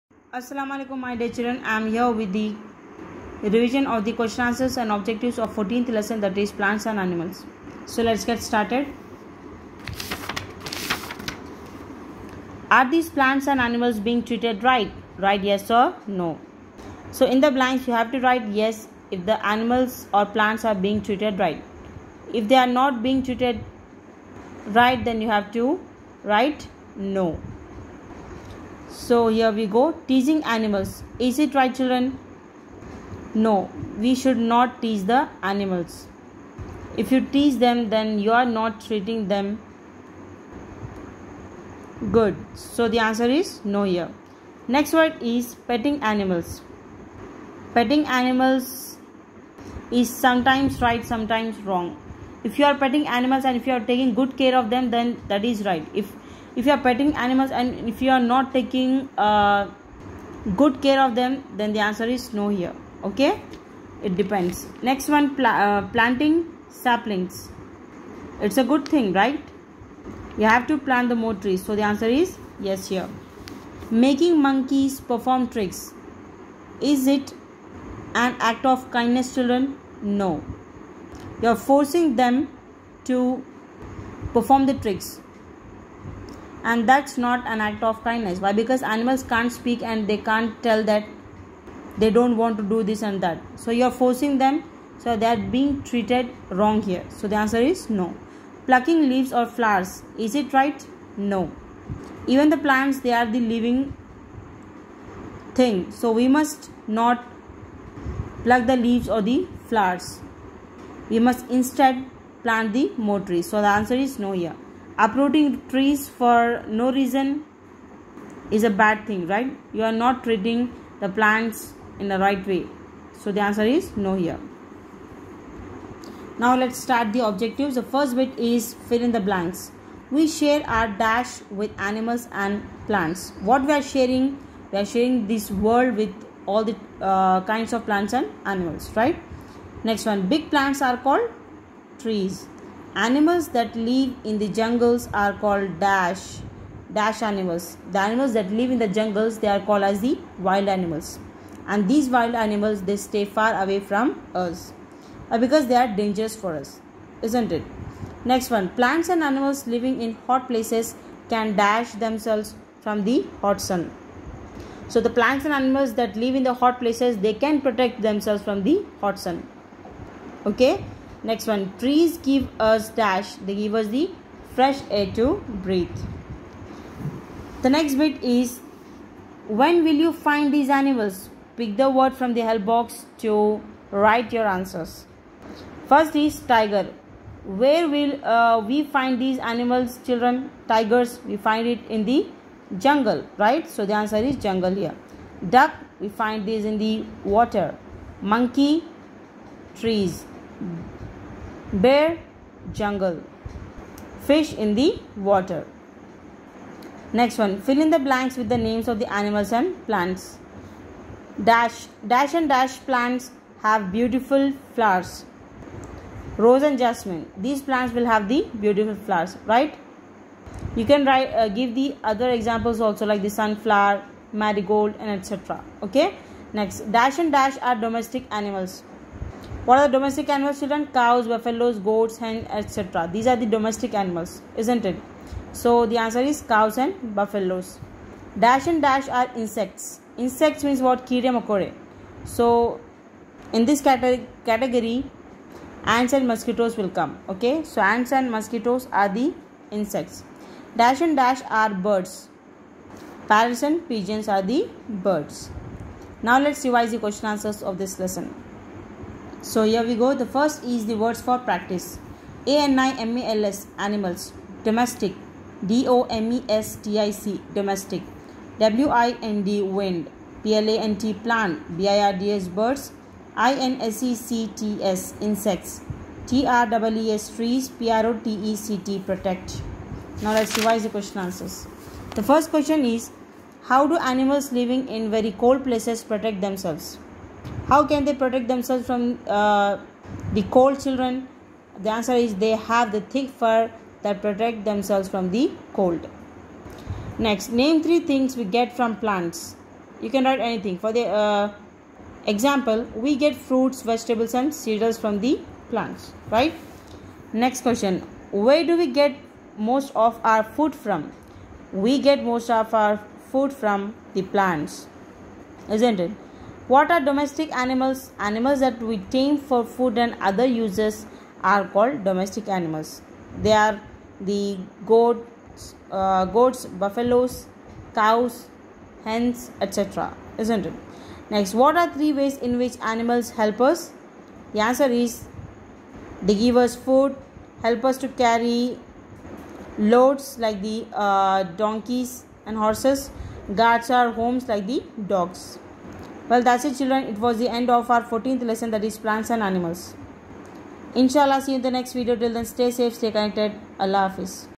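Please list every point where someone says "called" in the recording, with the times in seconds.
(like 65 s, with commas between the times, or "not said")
140 s, 145 s, 149 s, 321 s.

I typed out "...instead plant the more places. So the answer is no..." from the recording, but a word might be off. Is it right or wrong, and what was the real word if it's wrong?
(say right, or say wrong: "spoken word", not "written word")
wrong: "trees", not "places".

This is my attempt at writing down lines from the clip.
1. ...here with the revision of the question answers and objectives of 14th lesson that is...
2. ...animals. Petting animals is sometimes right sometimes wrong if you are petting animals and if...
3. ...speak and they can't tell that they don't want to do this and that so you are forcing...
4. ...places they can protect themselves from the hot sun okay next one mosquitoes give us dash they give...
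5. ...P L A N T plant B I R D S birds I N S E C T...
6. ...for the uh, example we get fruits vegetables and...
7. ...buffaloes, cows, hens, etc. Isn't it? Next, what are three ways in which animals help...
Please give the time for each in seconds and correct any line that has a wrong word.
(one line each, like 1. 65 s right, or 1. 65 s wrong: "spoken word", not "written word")
1. 1 s right
2. 46 s right
3. 89 s right
4. 166 s wrong: "trees", not "mosquitoes"
5. 270 s right
6. 300 s right
7. 326 s right.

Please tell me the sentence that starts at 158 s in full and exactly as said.
Next one plants and animals living in hot places can dash themselves from the hot sun.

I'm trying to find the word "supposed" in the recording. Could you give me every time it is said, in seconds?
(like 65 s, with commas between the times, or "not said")
not said.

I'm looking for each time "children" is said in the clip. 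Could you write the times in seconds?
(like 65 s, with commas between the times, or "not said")
1 s, 31 s, 79 s, 190 s, 230 s, 290 s, 346 s.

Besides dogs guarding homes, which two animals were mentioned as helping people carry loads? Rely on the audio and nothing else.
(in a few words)
Donkeys and horses.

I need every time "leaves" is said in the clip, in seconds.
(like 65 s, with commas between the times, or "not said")
99 s, 108 s.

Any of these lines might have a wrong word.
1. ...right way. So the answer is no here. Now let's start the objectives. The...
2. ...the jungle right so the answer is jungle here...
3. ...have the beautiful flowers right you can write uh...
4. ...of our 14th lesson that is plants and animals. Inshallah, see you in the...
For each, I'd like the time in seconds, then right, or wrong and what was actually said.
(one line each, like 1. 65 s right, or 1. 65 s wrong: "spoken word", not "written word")
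1. 122 s right
2. 192 s right
3. 218 s right
4. 347 s right.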